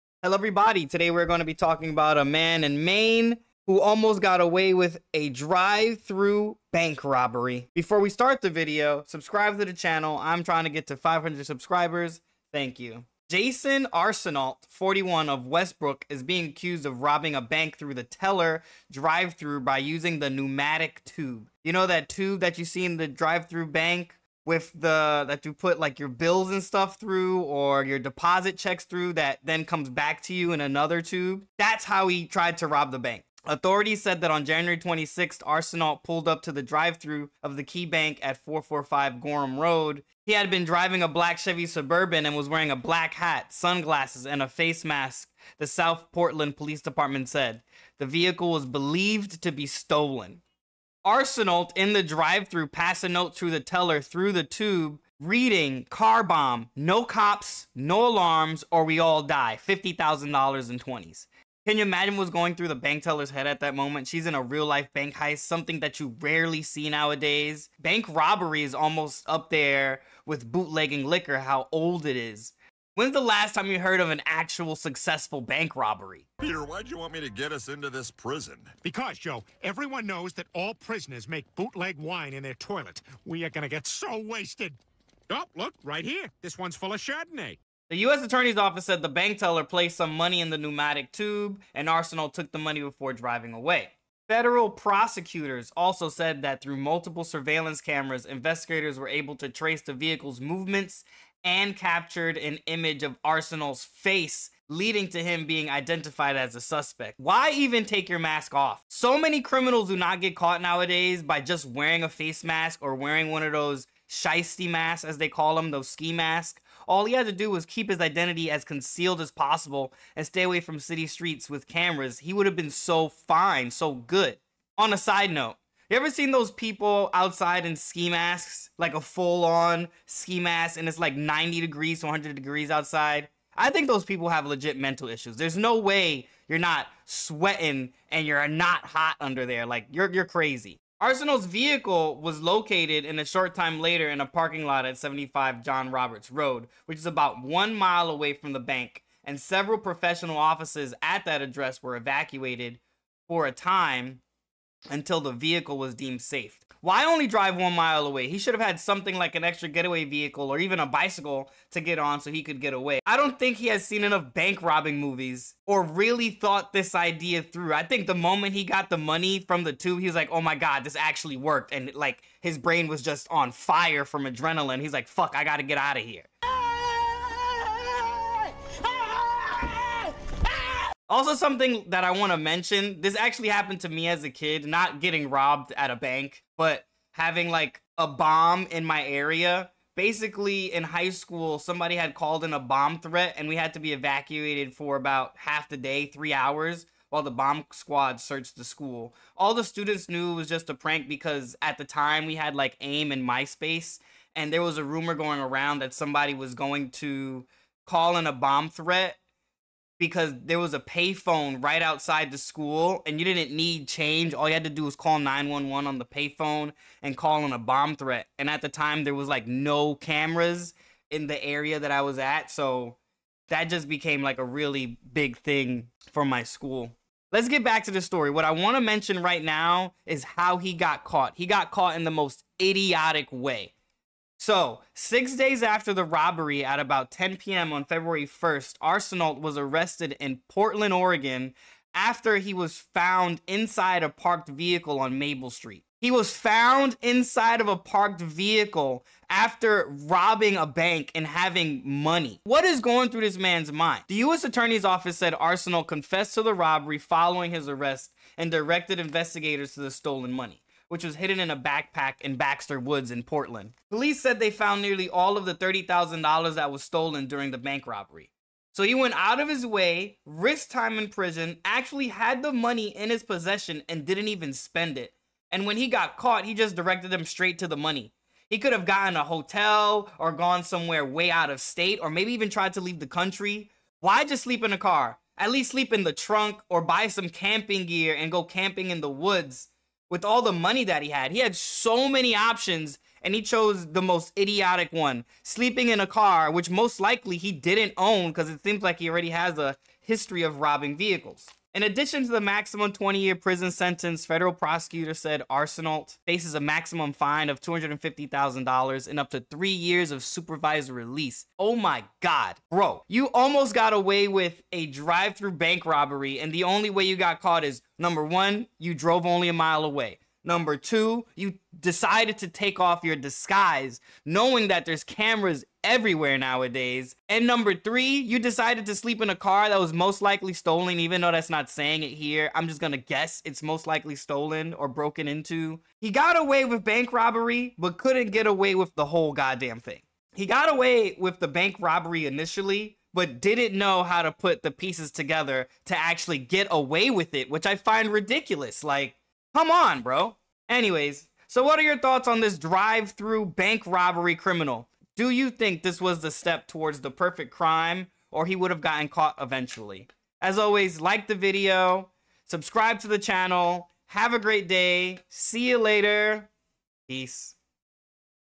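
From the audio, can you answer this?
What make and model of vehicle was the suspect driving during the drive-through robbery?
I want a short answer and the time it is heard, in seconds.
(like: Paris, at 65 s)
Chevy Suburban, at 41 s.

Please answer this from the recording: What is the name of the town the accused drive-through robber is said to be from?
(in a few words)
Westbrook.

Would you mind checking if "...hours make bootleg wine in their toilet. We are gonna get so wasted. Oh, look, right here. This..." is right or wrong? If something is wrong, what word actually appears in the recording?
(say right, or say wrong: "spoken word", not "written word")
wrong: "prisoners", not "hours".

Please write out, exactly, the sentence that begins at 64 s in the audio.
She's in a real life bank heist, something that you rarely see nowadays.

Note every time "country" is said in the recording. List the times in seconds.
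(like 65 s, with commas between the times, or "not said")
283 s.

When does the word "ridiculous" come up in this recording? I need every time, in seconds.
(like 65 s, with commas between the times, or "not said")
348 s.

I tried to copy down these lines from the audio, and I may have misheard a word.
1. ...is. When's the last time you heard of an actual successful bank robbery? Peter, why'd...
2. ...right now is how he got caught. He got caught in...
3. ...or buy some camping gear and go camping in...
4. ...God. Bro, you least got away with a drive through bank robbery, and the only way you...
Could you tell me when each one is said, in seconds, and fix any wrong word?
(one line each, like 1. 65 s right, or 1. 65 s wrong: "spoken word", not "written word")
1. 72 s right
2. 229 s right
3. 286 s right
4. 312 s wrong: "almost", not "least".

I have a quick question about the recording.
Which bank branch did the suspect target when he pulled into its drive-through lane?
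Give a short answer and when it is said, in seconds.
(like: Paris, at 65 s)
Key Bank, at 37 s.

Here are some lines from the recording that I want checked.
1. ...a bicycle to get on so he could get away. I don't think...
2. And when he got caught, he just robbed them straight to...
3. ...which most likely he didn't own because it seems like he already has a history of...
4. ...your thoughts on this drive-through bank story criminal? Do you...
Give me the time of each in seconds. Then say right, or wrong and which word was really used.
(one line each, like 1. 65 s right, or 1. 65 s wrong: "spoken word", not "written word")
1. 160 s right
2. 275 s wrong: "directed", not "robbed"
3. 296 s right
4. 351 s wrong: "robbery", not "story".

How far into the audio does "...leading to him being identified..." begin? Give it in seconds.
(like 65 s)
104 s.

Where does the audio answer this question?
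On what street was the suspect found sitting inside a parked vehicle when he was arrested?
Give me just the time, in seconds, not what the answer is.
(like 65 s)
245 s.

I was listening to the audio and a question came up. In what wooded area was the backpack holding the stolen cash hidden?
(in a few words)
Baxter Woods.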